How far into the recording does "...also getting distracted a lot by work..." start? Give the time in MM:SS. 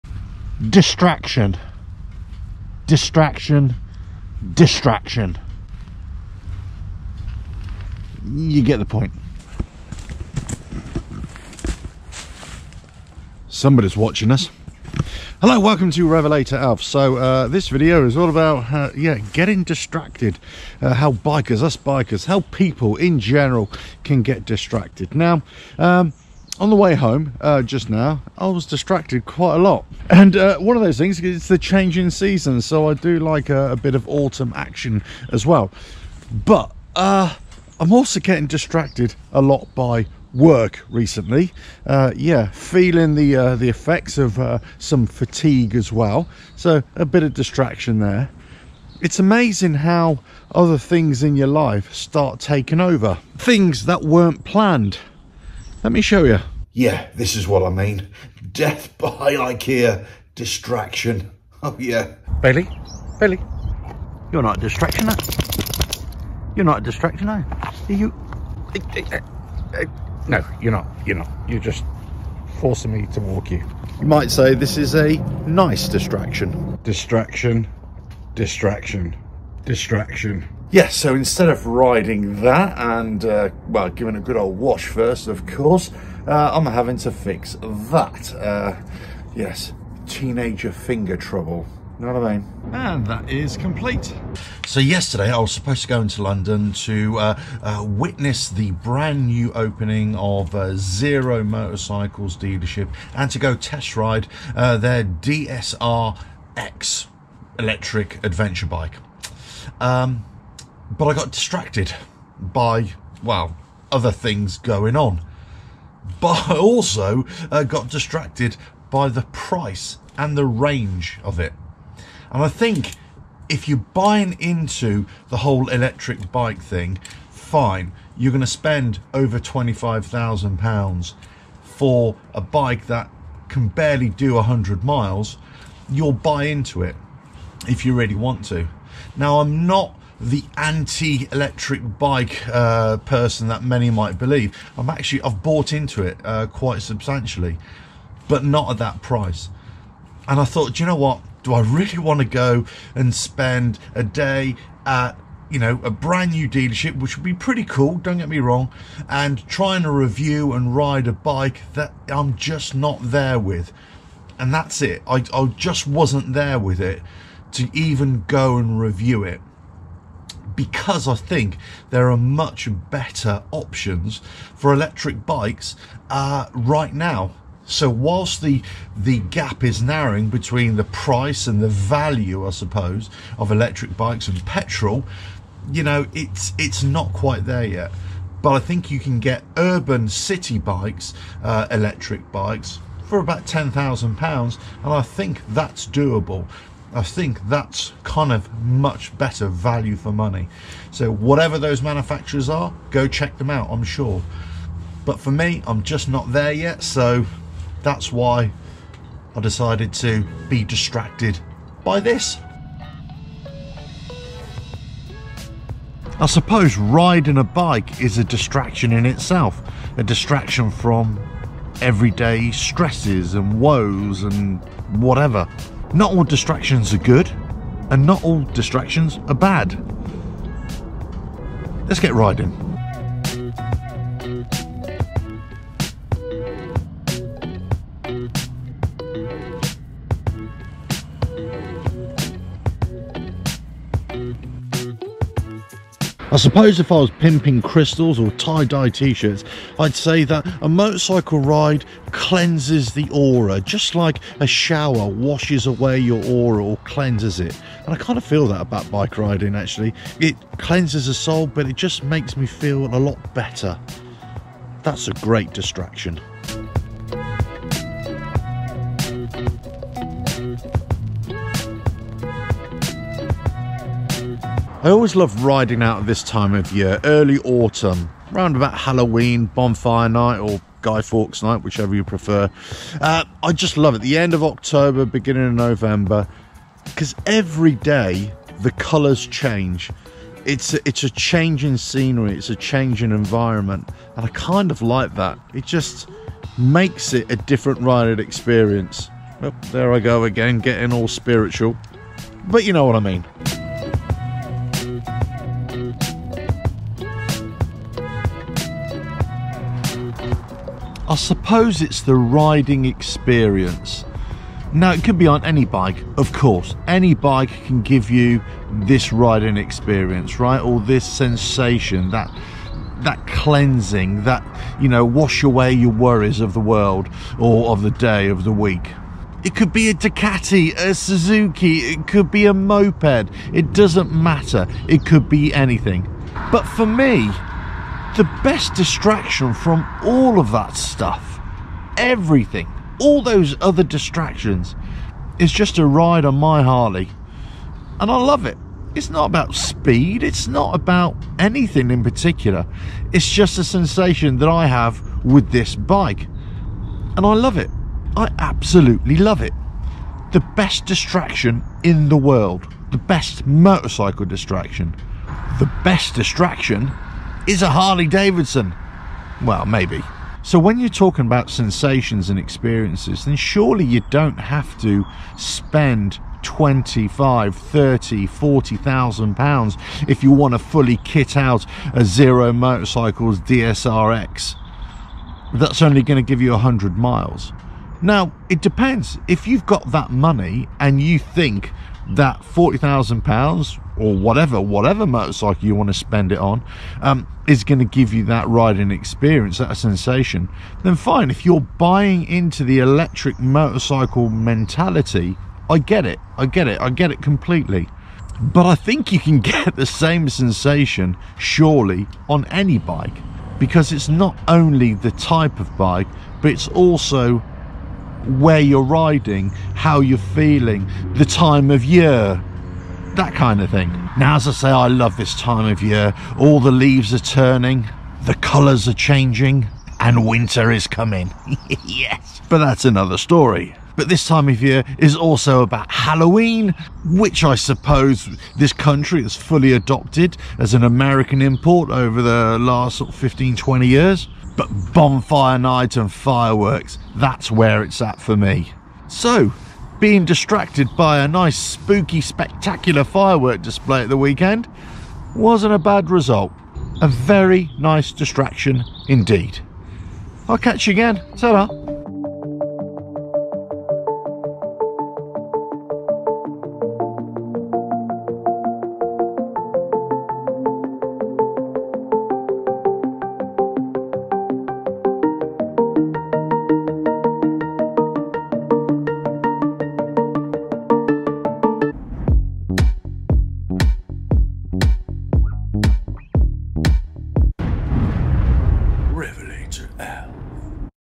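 00:37.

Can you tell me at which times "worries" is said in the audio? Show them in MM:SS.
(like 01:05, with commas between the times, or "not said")
05:25.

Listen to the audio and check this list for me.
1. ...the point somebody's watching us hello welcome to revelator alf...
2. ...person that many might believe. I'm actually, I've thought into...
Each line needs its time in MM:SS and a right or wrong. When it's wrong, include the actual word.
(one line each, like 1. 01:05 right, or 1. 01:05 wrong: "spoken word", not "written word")
1. 00:08 right
2. 02:22 wrong: "bought", not "thought".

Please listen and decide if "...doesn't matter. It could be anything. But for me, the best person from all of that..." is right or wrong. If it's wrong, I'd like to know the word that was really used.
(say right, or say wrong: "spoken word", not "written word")
wrong: "distraction", not "person".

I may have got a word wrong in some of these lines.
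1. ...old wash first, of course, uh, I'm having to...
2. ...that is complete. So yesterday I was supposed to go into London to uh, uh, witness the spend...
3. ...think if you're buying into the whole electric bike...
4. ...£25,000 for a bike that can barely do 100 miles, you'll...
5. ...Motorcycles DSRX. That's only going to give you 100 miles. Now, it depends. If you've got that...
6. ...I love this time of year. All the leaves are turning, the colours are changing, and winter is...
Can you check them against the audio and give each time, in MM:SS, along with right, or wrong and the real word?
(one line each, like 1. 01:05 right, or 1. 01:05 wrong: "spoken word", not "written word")
1. 01:24 right
2. 01:33 wrong: "brand", not "spend"
3. 02:02 right
4. 02:09 right
5. 06:22 right
6. 07:04 right.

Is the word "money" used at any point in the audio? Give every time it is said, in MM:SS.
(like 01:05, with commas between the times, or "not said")
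03:20, 06:30.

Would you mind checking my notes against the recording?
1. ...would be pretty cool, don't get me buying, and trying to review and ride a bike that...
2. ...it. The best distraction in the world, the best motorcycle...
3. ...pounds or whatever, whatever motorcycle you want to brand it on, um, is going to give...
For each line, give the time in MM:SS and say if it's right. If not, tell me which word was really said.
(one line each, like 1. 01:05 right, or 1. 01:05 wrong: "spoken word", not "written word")
1. 02:37 wrong: "wrong", not "buying"
2. 05:59 right
3. 06:33 wrong: "spend", not "brand".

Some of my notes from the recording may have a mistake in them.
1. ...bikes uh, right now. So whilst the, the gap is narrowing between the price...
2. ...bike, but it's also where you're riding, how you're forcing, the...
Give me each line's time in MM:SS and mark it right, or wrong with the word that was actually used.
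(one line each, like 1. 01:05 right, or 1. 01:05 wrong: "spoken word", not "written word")
1. 02:55 right
2. 06:55 wrong: "feeling", not "forcing".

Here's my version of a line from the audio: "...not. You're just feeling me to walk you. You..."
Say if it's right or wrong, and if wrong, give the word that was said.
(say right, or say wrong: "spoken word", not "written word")
wrong: "forcing", not "feeling".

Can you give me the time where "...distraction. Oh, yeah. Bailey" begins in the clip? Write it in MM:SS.
01:00.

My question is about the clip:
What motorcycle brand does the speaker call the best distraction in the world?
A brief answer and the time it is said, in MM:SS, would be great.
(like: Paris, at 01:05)
Harley Davidson, at 06:07.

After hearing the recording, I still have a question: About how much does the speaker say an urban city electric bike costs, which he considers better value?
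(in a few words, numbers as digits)
£10,000.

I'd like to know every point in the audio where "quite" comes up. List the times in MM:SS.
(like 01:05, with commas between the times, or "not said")
00:29, 02:26, 03:07.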